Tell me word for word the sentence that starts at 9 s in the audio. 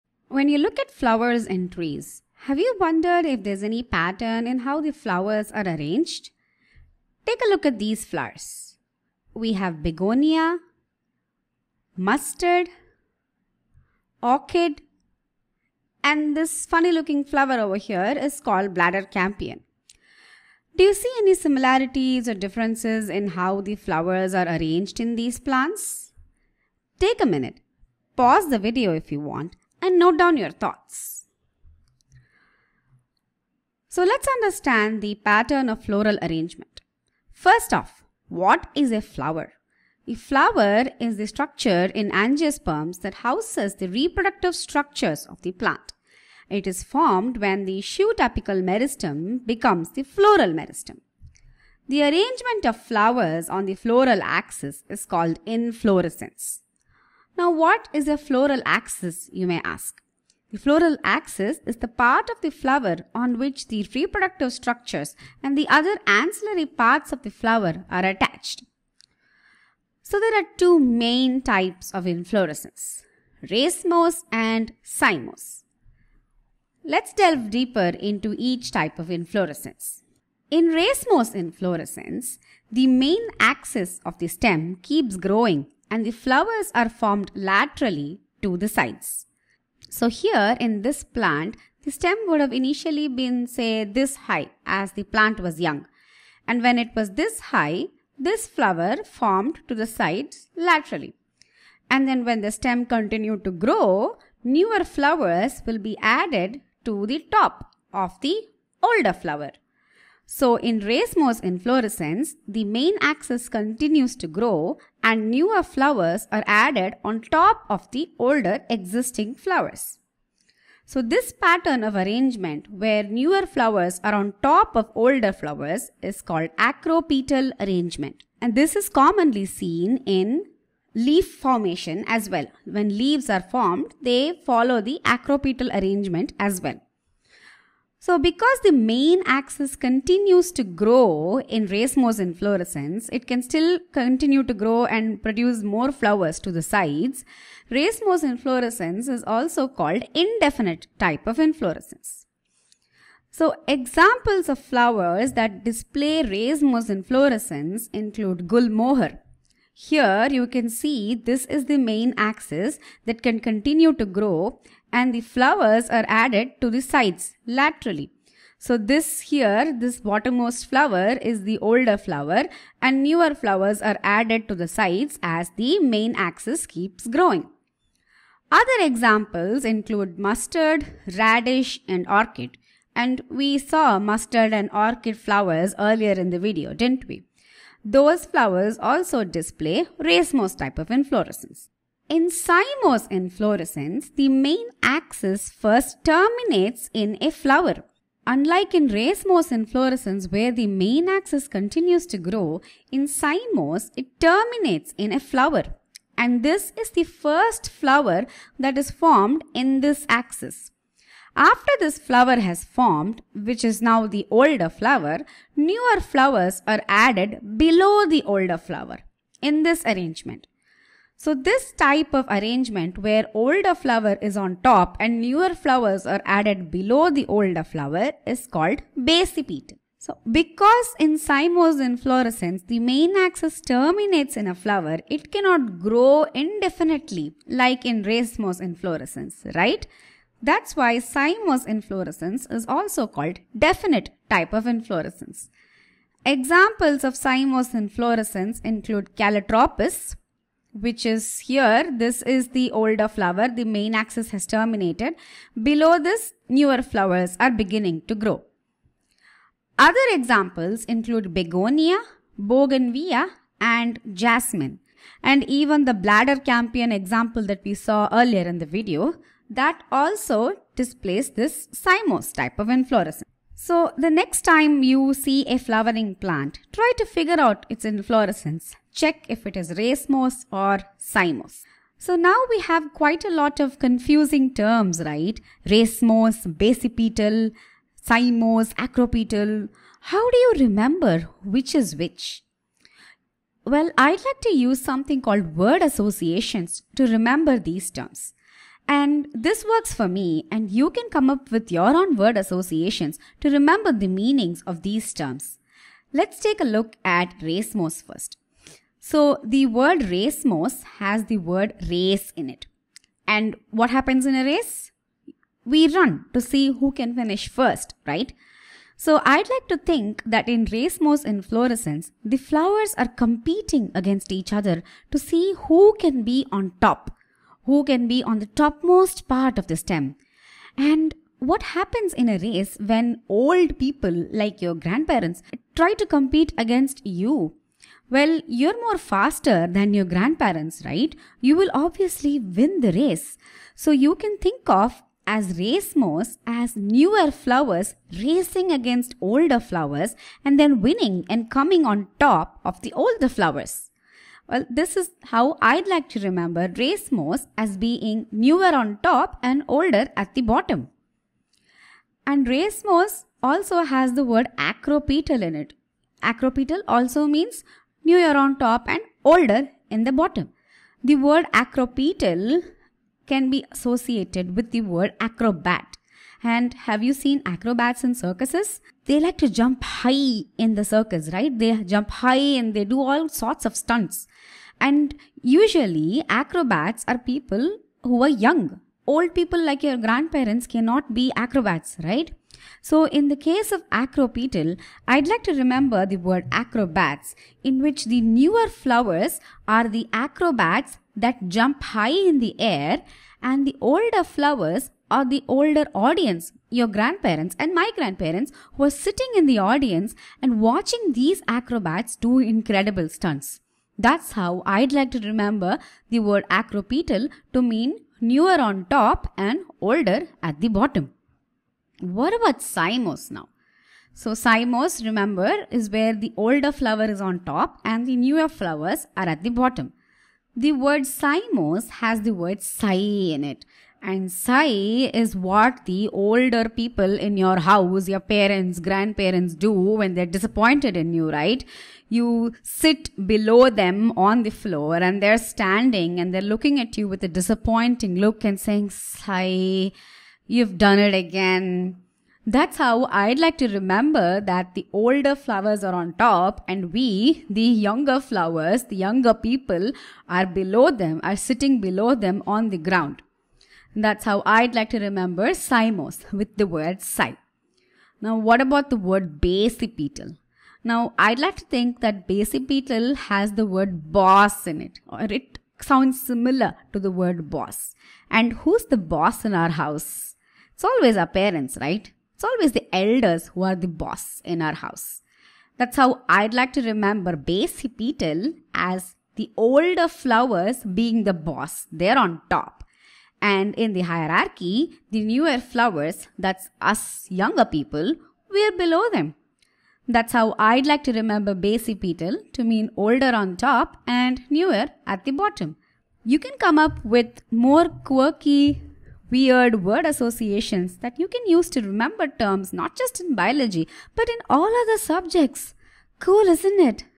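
We have begonia, mustard, orchid, and this funny looking flower over here is called bladder campion.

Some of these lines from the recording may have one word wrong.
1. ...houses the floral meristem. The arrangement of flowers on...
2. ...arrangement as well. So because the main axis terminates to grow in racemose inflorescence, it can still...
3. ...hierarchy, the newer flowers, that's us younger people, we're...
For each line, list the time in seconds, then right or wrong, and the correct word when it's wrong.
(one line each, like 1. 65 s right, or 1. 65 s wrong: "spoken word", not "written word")
1. 49 s wrong: "becomes", not "houses"
2. 135 s wrong: "continues", not "terminates"
3. 494 s right.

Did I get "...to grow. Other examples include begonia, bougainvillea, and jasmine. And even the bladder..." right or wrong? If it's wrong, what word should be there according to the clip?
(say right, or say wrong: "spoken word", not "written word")
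right.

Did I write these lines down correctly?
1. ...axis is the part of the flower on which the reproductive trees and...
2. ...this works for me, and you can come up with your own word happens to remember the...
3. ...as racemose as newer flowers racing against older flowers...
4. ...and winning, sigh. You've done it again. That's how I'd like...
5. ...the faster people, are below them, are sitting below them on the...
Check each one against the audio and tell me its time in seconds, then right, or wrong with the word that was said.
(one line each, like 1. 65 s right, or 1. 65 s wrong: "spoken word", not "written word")
1. 61 s wrong: "structures", not "trees"
2. 299 s wrong: "associations", not "happens"
3. 345 s right
4. 448 s wrong: "saying", not "winning"
5. 458 s wrong: "younger", not "faster".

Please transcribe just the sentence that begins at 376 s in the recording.
And have you seen acrobats in circuses?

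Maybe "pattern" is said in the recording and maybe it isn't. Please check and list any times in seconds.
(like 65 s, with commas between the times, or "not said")
3 s, 35 s, 121 s.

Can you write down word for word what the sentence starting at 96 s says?
And when it was this high, this flower formed to the sides laterally.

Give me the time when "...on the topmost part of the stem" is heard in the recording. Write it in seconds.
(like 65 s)
328 s.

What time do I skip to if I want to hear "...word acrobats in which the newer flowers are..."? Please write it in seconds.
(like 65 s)
396 s.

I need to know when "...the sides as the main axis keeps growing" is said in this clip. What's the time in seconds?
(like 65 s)
174 s.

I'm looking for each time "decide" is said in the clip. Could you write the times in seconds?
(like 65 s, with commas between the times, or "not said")
not said.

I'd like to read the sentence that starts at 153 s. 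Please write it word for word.
So examples of flowers that display racemose inflorescence include gulmohar.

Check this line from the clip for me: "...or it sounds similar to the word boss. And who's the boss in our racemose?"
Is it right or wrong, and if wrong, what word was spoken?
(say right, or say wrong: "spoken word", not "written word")
wrong: "house", not "racemose".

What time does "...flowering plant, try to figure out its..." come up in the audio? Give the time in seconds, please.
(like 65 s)
275 s.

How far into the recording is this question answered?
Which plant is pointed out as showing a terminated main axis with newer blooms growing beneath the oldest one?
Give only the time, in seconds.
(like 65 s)
249 s.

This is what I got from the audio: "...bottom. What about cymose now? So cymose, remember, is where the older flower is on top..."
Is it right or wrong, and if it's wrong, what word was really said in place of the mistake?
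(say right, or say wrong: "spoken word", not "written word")
right.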